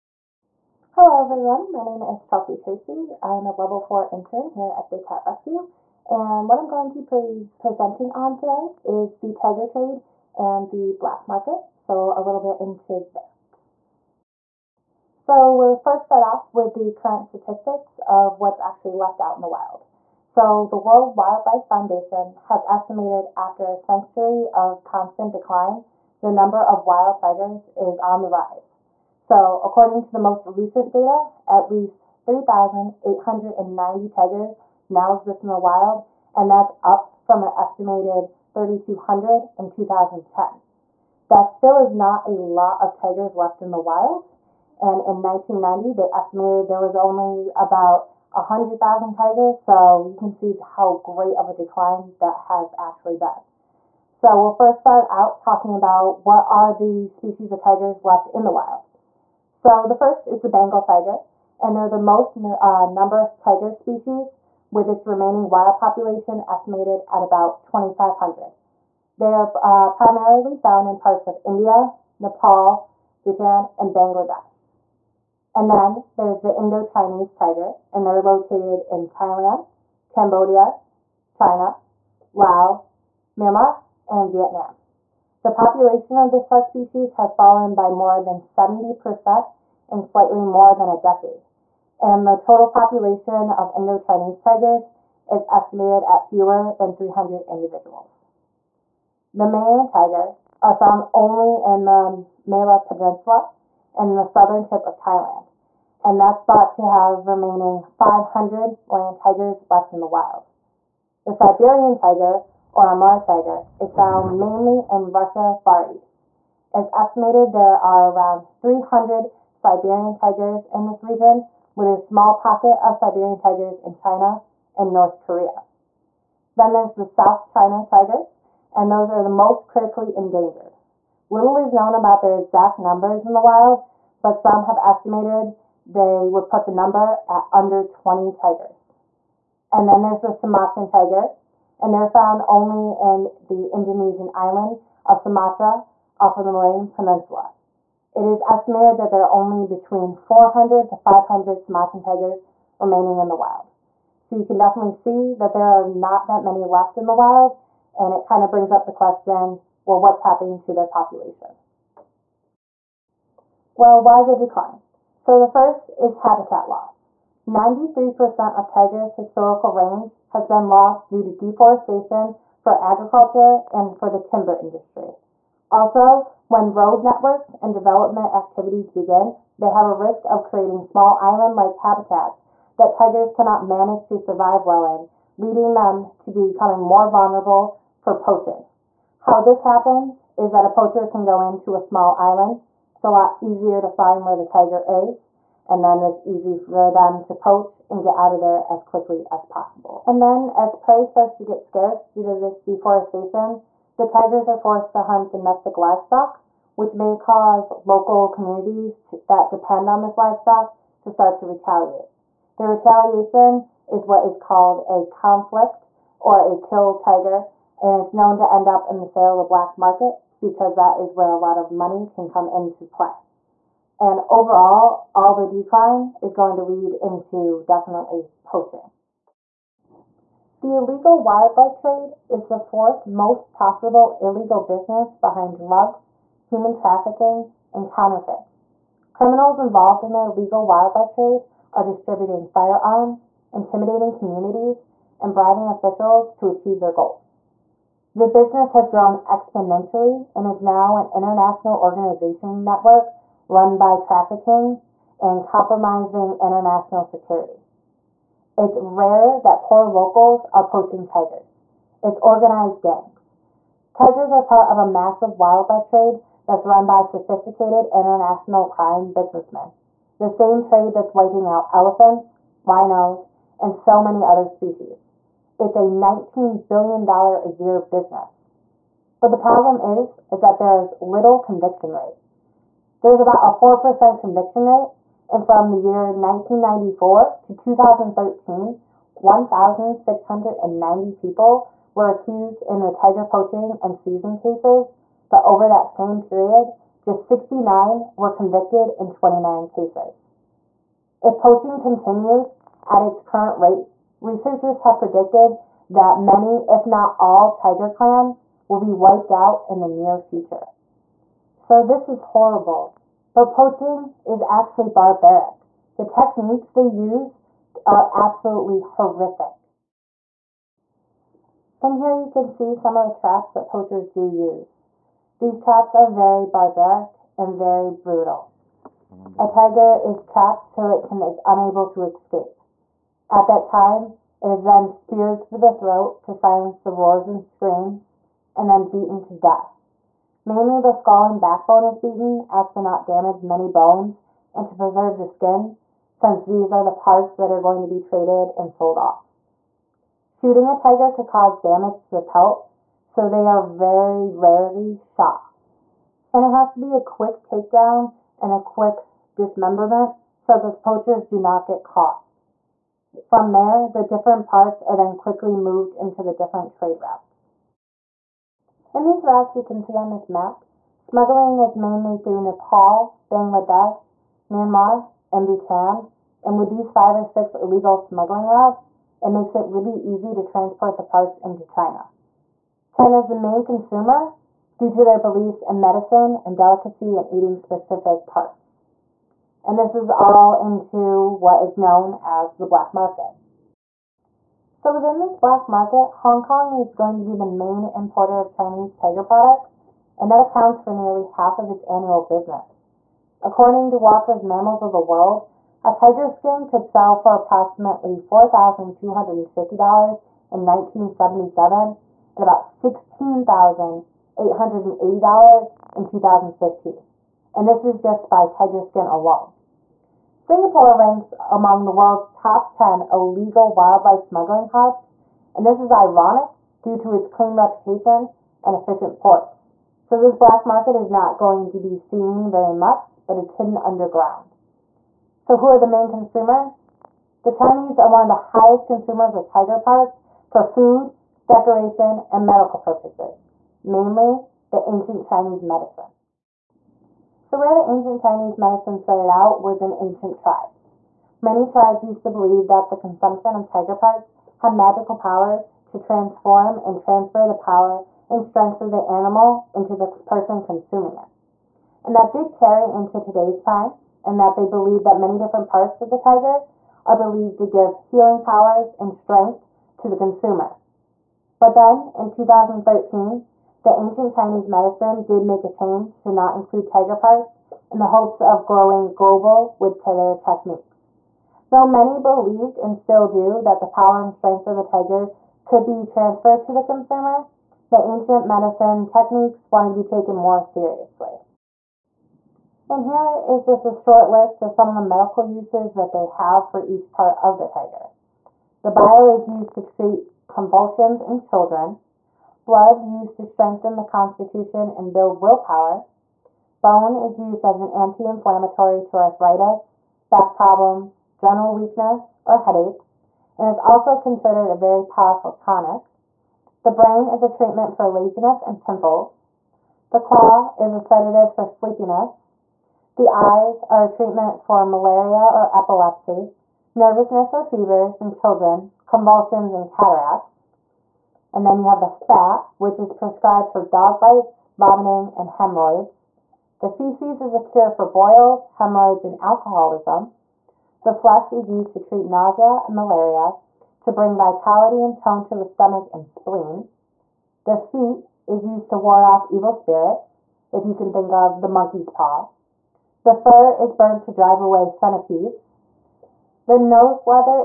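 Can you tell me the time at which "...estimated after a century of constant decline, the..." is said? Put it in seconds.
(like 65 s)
22 s.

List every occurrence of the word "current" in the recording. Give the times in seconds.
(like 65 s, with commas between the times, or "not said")
16 s, 303 s.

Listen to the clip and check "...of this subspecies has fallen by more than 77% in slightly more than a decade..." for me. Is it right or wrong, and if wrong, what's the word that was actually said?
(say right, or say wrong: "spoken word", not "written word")
wrong: "70", not "77".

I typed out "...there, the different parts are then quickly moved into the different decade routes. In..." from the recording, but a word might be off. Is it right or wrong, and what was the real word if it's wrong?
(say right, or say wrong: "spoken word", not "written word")
wrong: "trade", not "decade".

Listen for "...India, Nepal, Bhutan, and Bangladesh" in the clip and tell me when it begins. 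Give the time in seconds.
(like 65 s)
71 s.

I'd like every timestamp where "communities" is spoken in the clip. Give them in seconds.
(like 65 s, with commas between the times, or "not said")
208 s, 244 s.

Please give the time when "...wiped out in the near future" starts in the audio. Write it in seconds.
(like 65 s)
308 s.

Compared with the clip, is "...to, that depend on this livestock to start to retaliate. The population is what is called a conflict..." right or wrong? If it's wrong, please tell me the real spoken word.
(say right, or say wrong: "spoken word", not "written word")
wrong: "retaliation", not "population".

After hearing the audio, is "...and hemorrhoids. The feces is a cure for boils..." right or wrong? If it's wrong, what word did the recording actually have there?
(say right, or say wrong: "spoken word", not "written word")
right.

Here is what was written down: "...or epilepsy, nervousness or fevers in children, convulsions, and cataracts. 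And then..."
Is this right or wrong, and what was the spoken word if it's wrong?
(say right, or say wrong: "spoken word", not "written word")
right.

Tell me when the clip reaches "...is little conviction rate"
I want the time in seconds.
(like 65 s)
280 s.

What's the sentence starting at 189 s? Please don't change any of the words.
How this happens is that a poacher can go into a small island.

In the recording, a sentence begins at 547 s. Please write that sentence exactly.
The feet is used to ward off evil spirits, if you can think of the monkey's paw.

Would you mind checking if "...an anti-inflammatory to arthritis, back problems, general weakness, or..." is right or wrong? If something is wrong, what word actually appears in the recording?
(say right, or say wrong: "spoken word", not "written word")
right.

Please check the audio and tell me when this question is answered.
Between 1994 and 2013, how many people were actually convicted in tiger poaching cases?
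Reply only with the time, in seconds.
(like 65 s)
297 s.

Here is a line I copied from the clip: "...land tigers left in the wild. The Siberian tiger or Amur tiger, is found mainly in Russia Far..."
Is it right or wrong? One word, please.
right.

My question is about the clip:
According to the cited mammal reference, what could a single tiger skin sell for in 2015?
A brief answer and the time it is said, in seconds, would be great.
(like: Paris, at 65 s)
$16,880, at 412 s.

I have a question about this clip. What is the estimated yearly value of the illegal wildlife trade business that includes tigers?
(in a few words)
$19 billion.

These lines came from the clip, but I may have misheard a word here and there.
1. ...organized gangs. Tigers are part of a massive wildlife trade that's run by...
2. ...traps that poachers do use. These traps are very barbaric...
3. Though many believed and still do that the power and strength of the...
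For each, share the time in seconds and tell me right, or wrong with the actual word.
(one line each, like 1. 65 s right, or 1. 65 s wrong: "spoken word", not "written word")
1. 262 s right
2. 323 s right
3. 481 s right.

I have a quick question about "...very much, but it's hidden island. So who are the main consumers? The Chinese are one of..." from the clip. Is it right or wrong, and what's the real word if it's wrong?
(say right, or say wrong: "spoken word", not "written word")
wrong: "underground", not "island".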